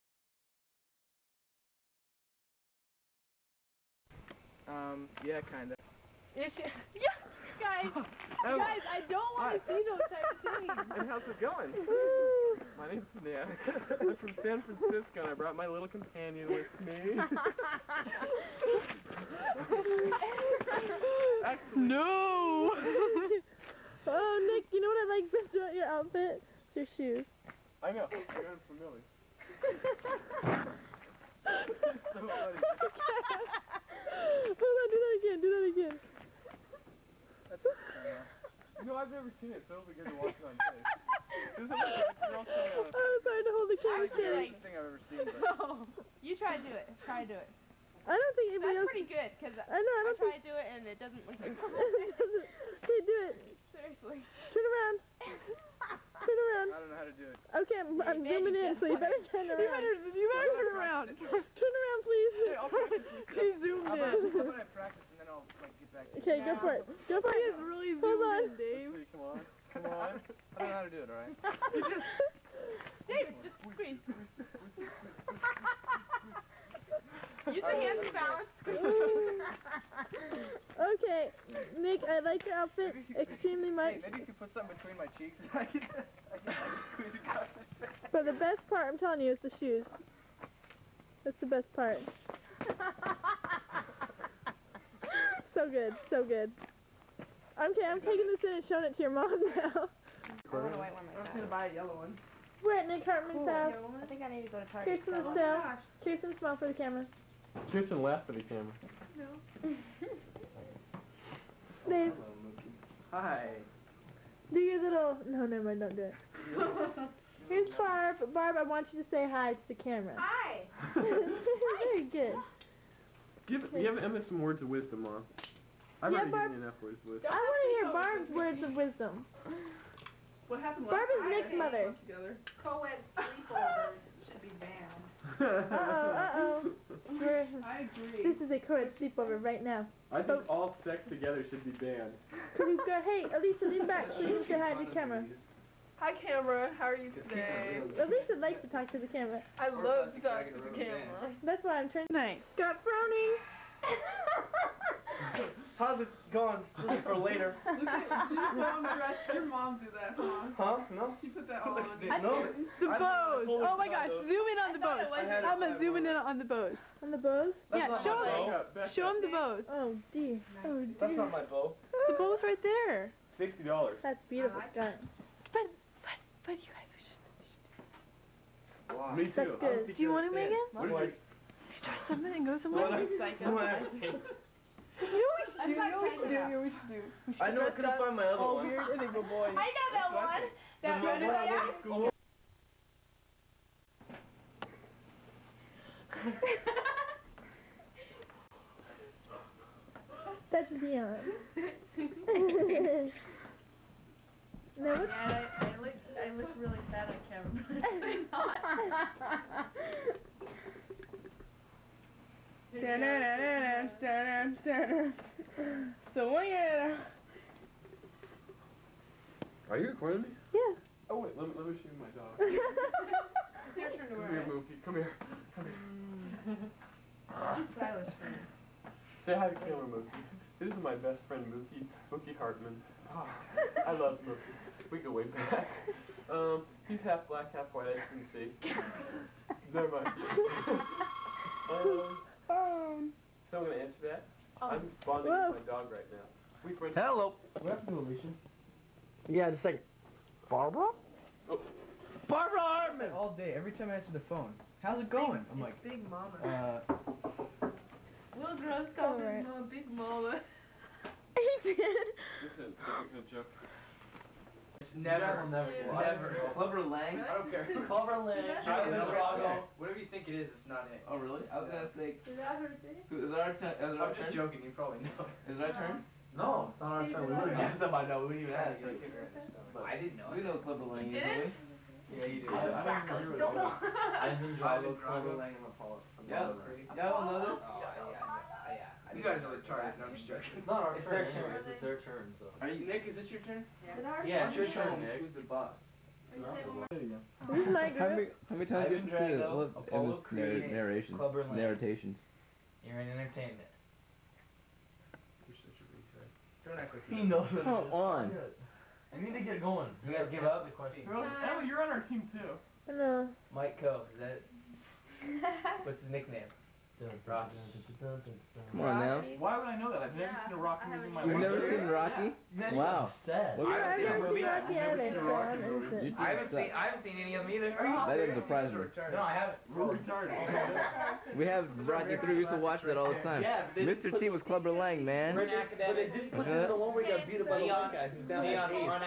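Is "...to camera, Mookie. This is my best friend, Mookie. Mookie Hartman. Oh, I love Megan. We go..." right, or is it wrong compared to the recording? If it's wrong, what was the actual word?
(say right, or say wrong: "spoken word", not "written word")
wrong: "Mookie", not "Megan".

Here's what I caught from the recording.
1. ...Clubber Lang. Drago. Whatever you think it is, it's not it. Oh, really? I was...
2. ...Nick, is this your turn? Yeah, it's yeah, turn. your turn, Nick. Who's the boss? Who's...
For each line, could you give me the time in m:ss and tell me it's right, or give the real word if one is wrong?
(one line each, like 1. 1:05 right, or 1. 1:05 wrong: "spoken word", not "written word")
1. 4:27 right
2. 4:52 right.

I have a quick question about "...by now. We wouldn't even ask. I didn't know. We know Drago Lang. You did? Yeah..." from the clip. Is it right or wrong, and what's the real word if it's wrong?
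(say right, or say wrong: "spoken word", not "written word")
wrong: "Clubber", not "Drago".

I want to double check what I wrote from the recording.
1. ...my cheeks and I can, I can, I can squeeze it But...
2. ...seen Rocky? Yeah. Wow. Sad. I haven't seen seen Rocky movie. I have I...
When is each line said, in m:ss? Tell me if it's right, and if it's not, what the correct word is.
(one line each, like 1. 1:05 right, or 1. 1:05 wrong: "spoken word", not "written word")
1. 1:24 right
2. 5:21 right.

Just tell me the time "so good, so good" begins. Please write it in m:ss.
1:35.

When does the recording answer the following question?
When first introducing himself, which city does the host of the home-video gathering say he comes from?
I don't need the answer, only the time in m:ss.
0:14.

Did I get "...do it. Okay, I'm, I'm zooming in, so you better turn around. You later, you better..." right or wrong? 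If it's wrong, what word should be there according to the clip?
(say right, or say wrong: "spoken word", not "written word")
wrong: "better", not "later".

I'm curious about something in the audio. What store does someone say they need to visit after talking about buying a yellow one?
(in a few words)
Target.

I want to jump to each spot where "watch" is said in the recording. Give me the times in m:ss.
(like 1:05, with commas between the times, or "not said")
0:40, 5:32.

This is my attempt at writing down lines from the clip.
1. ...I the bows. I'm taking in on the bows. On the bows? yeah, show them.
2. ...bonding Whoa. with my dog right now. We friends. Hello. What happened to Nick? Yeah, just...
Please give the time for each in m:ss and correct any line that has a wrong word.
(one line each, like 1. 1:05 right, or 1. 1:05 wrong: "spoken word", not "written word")
1. 2:44 wrong: "zooming", not "taking"
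2. 4:05 wrong: "Alicia", not "Nick".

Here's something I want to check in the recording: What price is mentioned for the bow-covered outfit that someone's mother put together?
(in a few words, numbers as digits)
$60.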